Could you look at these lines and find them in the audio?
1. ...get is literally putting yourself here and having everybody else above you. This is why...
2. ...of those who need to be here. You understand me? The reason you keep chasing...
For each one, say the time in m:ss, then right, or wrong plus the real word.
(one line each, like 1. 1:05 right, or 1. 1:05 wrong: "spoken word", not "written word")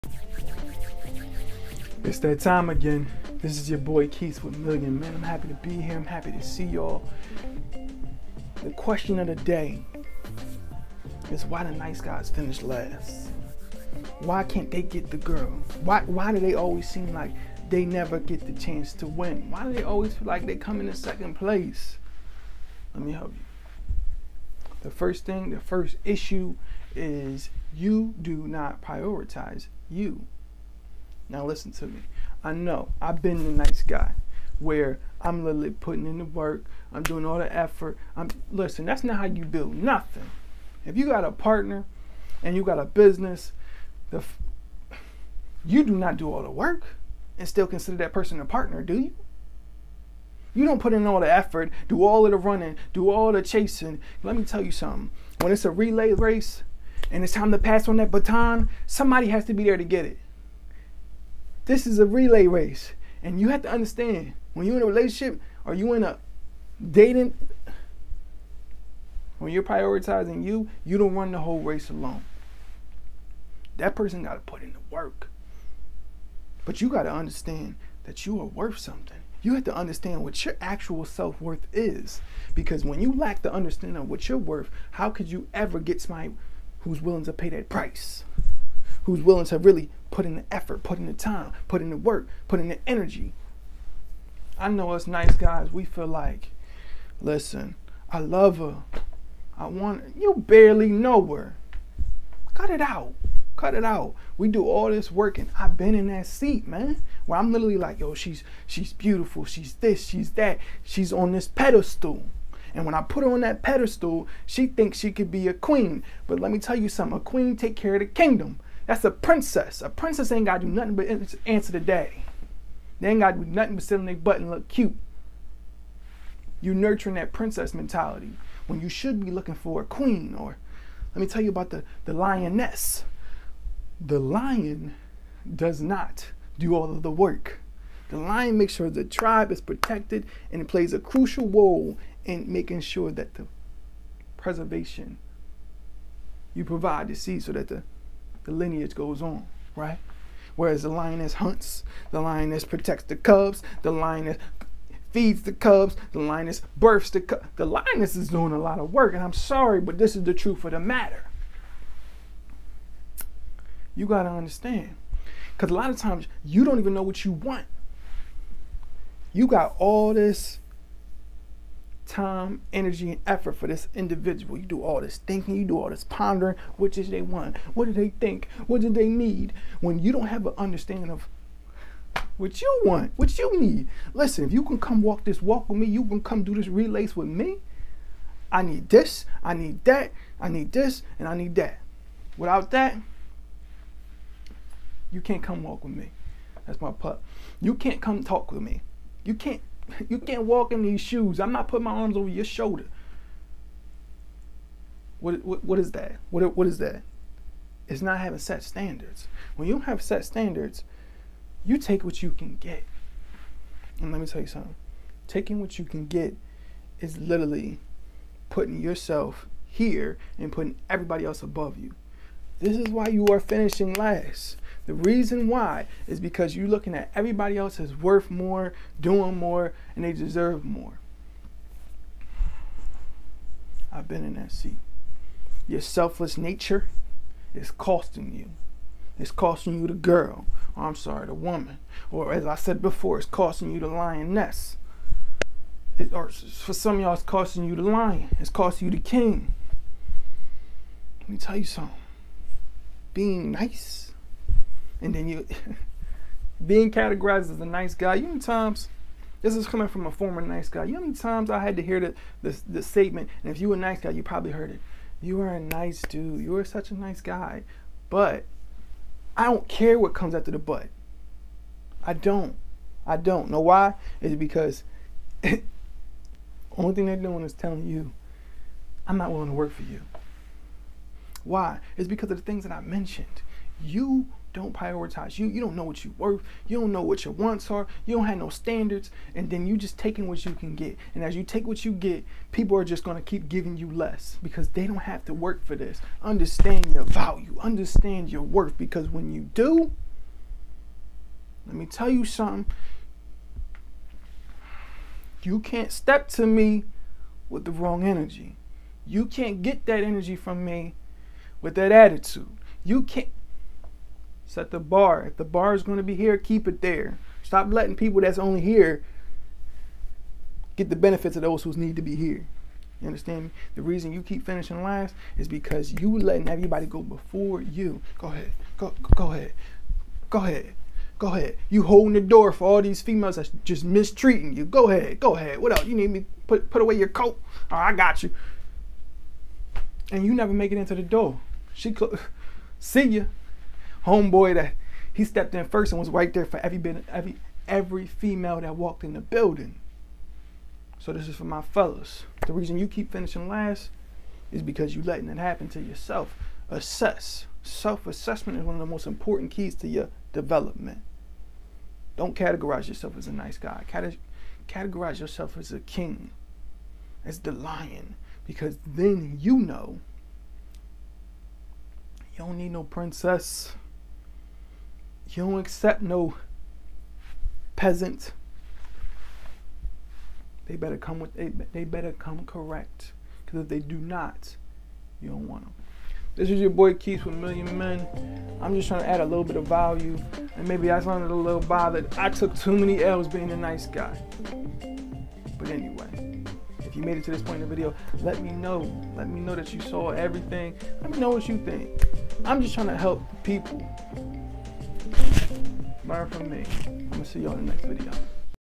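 1. 3:36 wrong: "putting", not "having"
2. 5:21 wrong: "finishing", not "chasing".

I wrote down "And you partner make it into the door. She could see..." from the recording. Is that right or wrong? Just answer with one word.
wrong.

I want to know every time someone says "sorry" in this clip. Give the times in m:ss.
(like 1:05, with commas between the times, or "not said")
2:39, 4:00.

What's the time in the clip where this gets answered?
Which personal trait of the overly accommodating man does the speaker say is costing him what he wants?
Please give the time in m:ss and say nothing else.
3:55.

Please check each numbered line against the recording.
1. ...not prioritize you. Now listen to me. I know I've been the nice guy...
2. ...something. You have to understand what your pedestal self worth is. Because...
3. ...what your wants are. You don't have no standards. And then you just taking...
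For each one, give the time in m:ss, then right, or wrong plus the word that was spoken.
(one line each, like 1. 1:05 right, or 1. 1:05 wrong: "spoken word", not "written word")
1. 0:28 right
2. 1:18 wrong: "actual", not "pedestal"
3. 4:47 right.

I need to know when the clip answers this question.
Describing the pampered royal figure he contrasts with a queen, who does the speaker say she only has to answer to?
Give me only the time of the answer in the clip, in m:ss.
2:01.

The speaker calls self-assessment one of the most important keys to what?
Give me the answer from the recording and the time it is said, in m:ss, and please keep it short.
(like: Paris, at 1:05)
Your development, at 5:59.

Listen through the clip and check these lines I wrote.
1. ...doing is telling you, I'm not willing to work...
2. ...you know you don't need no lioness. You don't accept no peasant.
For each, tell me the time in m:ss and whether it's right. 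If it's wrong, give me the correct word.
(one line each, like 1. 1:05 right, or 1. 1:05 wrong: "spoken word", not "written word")
1. 4:37 right
2. 6:09 wrong: "princess", not "lioness".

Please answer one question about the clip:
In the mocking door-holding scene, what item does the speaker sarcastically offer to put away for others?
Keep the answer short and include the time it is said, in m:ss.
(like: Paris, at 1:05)
Your coat, at 5:36.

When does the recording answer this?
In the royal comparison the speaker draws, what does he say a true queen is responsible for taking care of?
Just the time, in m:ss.
1:57.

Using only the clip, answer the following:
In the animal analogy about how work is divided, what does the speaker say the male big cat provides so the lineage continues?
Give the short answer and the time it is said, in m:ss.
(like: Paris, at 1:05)
The seed, at 2:26.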